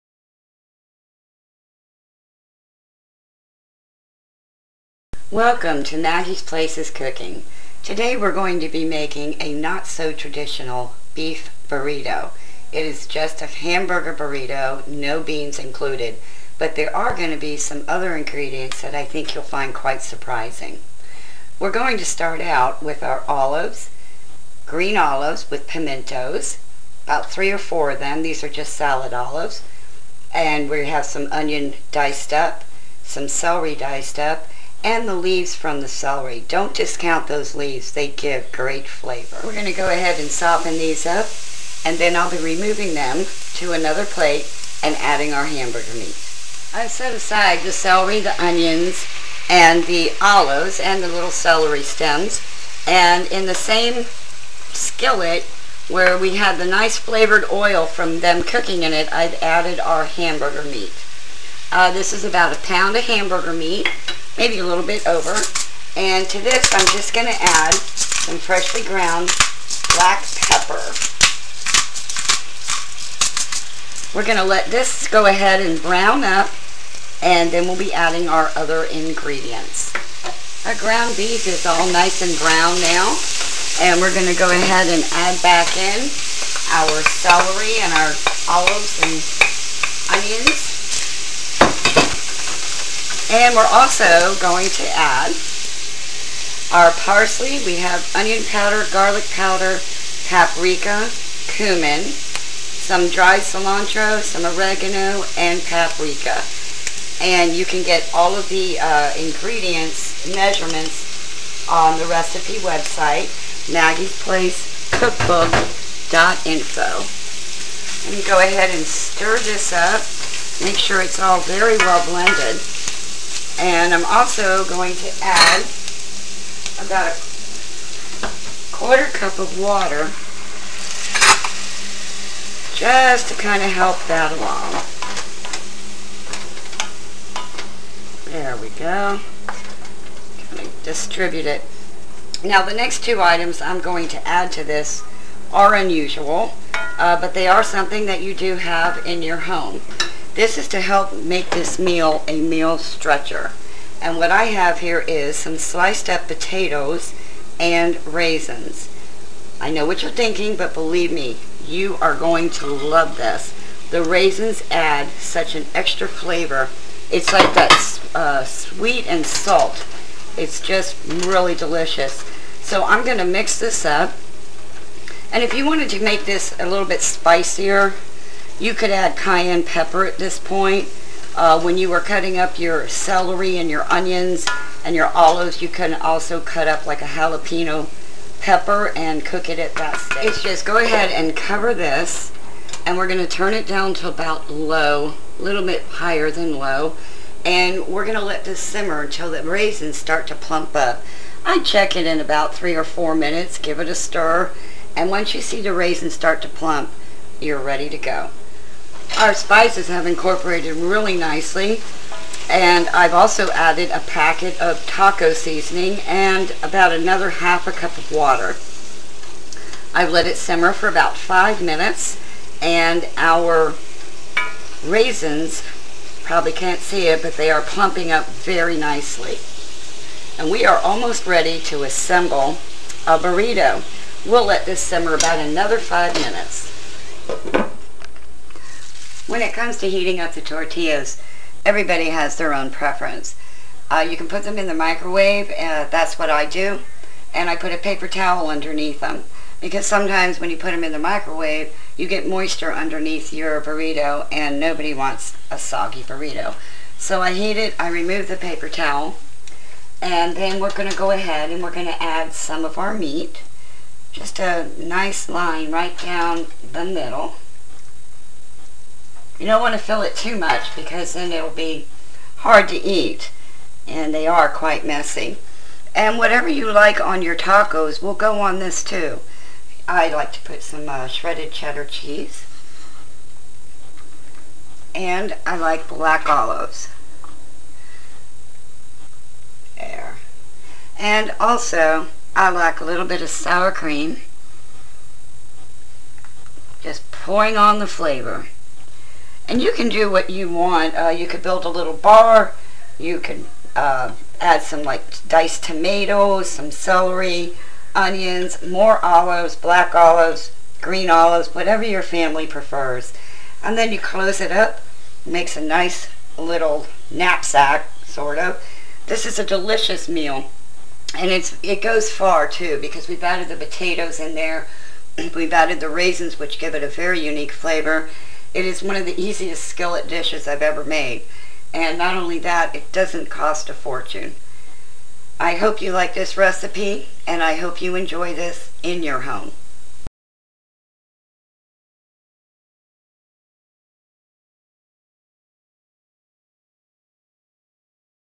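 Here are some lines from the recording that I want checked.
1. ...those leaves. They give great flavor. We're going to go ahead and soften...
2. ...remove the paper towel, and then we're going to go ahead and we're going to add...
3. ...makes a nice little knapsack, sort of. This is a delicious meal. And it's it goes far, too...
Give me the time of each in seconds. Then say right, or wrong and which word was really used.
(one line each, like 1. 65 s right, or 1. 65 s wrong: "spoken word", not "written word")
1. 37 s right
2. 257 s right
3. 315 s right.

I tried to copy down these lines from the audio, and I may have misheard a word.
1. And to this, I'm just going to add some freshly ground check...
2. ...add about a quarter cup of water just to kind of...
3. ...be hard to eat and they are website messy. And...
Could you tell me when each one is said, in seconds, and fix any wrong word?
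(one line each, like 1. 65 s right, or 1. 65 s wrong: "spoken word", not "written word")
1. 65 s wrong: "black", not "check"
2. 125 s right
3. 271 s wrong: "quite", not "website".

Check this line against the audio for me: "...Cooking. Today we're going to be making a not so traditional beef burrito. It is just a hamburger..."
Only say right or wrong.
right.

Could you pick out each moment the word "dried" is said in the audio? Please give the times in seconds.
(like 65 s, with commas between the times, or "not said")
103 s.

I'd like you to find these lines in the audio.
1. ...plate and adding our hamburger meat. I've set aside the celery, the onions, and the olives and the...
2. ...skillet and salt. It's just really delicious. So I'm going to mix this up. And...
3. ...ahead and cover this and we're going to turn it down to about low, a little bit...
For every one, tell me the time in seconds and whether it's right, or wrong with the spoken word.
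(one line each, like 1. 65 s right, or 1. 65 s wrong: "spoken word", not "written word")
1. 44 s right
2. 168 s wrong: "sweet", not "skillet"
3. 190 s right.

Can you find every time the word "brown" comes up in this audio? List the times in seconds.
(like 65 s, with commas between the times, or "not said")
75 s, 82 s.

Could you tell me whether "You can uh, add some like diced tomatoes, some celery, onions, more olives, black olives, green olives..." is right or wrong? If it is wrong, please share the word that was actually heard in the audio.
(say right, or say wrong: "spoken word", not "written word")
right.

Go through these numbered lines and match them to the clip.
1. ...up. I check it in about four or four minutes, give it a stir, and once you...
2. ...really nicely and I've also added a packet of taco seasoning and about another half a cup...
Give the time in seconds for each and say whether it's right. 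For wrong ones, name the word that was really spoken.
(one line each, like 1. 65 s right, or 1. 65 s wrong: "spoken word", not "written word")
1. 200 s wrong: "three", not "four"
2. 210 s right.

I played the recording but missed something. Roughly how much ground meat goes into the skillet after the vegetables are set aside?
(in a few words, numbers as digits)
about a pound.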